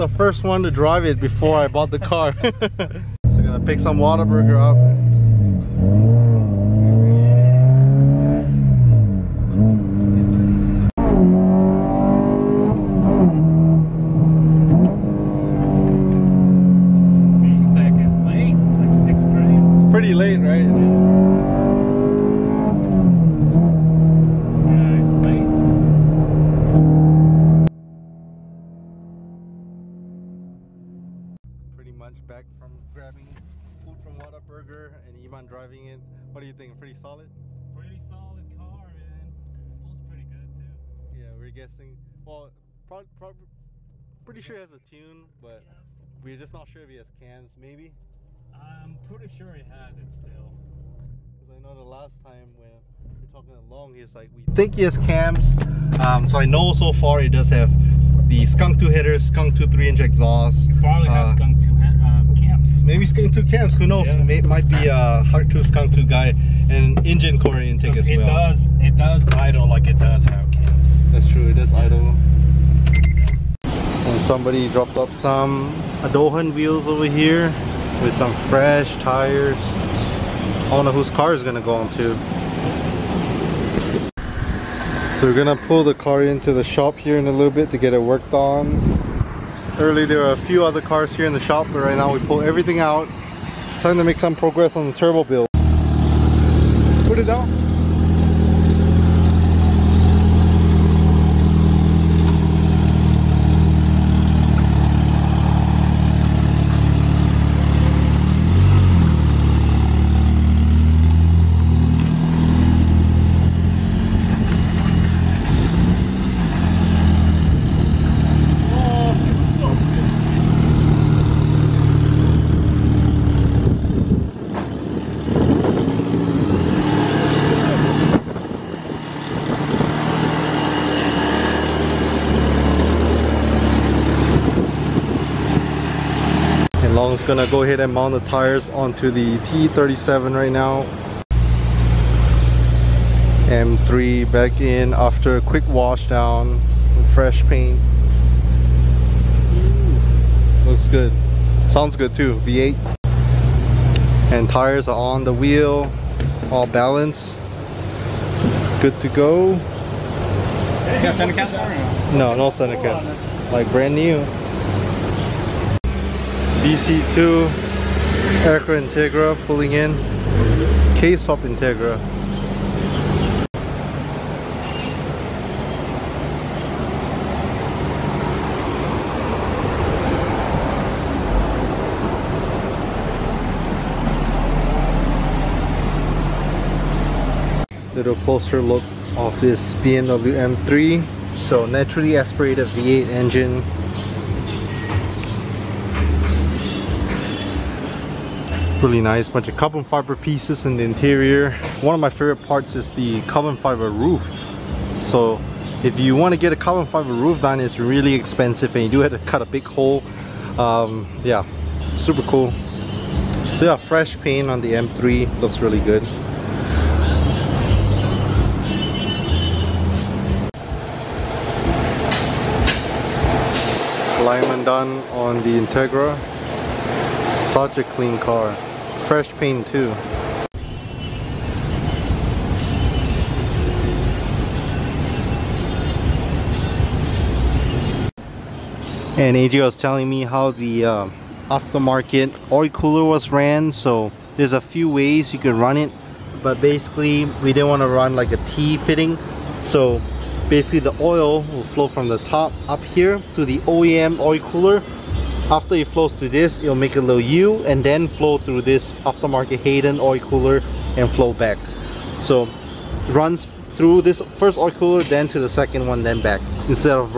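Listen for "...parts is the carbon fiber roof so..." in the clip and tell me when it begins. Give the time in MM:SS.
03:22.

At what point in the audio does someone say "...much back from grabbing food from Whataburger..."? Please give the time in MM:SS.
00:31.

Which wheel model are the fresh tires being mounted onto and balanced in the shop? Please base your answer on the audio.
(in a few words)
TE37.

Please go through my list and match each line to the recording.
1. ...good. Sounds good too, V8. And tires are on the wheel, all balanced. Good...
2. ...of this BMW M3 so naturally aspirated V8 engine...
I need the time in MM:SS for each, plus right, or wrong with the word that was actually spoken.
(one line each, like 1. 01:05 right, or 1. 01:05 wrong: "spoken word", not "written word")
1. 02:30 right
2. 03:09 right.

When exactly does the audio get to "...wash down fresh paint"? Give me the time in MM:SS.
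02:25.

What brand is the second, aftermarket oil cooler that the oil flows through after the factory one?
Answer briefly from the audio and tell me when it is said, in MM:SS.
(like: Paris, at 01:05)
Hayden, at 04:19.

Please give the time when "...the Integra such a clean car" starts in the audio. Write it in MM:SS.
03:45.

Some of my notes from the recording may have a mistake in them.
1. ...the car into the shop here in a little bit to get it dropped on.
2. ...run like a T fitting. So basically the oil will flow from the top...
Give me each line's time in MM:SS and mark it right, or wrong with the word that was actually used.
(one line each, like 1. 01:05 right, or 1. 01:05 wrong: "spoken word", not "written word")
1. 01:25 wrong: "worked", not "dropped"
2. 04:07 right.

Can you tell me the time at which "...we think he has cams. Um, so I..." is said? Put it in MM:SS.
00:54.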